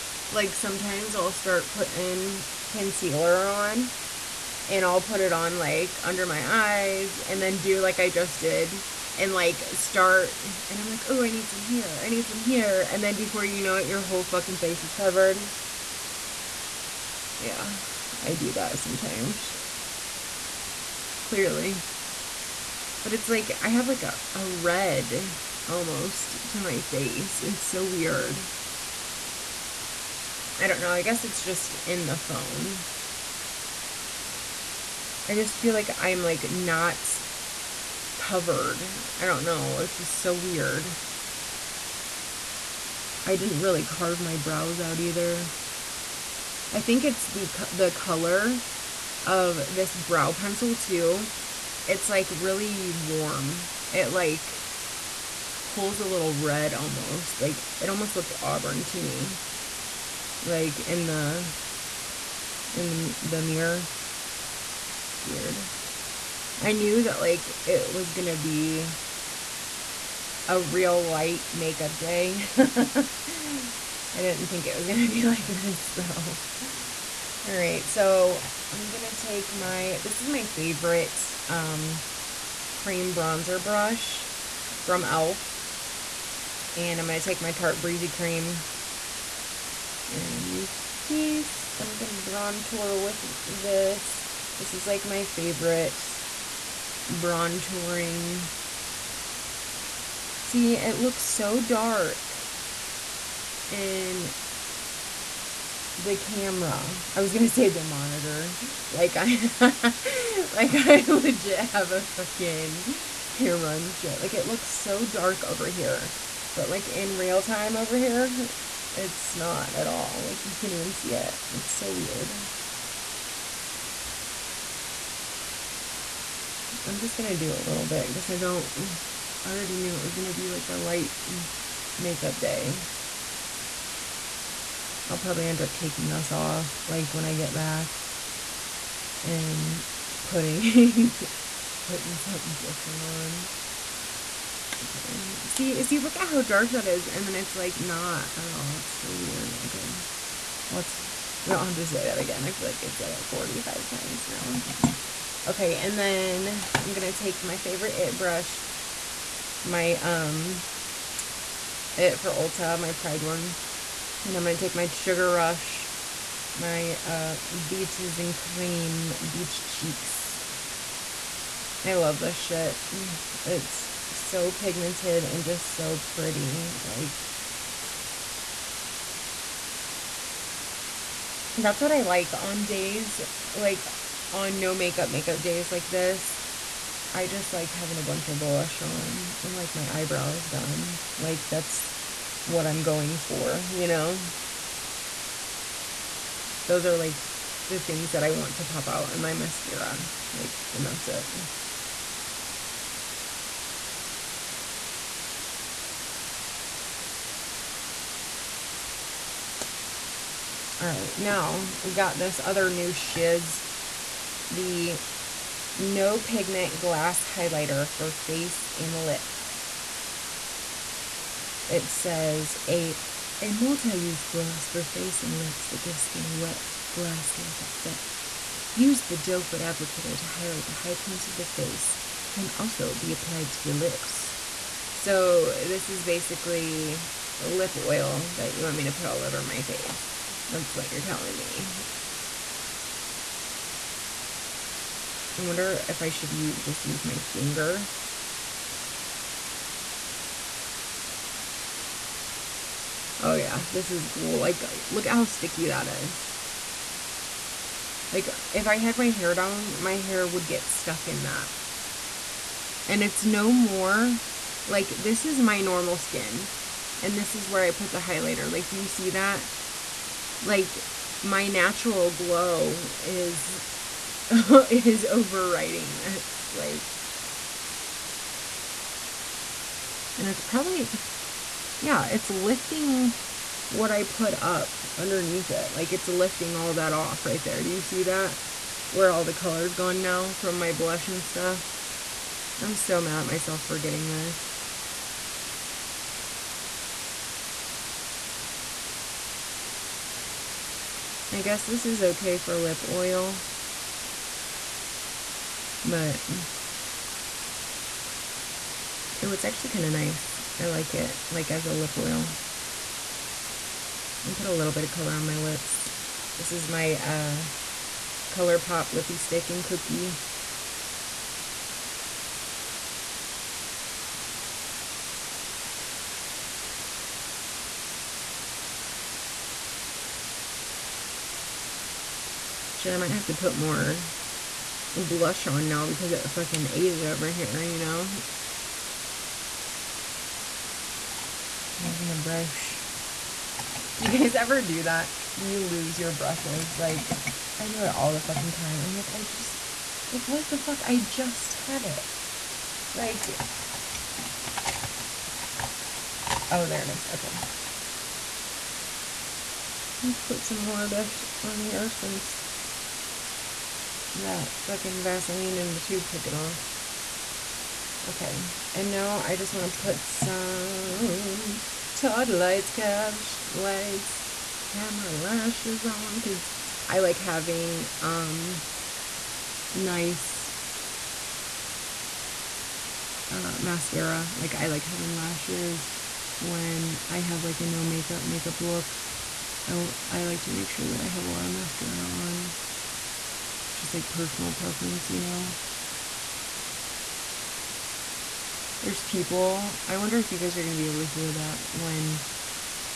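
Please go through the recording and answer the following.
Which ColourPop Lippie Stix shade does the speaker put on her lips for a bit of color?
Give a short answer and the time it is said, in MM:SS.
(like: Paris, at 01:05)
Cookie, at 05:19.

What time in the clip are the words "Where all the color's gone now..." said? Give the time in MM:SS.
04:48.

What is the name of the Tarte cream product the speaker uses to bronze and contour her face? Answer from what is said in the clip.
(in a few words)
Tarte Breezy Cream.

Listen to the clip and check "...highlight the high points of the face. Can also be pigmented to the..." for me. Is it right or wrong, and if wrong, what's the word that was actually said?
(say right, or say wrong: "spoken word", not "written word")
wrong: "applied", not "pigmented".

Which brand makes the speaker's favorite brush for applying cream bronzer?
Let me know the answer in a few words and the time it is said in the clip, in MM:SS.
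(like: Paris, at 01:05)
e.l.f., at 01:25.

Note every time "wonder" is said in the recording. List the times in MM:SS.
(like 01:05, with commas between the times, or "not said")
04:05, 06:39.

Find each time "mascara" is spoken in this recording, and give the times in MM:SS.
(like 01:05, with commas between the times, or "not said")
03:19, 06:23, 06:31.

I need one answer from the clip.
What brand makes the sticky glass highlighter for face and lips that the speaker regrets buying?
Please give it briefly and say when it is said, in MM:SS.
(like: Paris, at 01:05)
No Pigment, at 03:35.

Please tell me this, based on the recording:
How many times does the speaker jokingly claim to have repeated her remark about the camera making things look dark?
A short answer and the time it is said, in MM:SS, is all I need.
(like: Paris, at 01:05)
45, at 02:33.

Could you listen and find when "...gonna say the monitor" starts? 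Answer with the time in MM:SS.
01:47.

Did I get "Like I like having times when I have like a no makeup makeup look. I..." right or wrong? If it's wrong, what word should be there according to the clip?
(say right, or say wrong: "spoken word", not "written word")
wrong: "lashes", not "times".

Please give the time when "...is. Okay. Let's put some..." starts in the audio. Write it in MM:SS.
05:56.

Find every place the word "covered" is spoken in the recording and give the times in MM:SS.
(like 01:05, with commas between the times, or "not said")
00:14, 00:38.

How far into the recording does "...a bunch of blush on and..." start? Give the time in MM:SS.
03:07.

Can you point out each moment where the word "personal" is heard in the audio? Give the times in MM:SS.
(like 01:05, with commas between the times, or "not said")
06:34.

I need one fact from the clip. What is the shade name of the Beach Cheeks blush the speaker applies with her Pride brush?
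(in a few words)
Beaches and Cream.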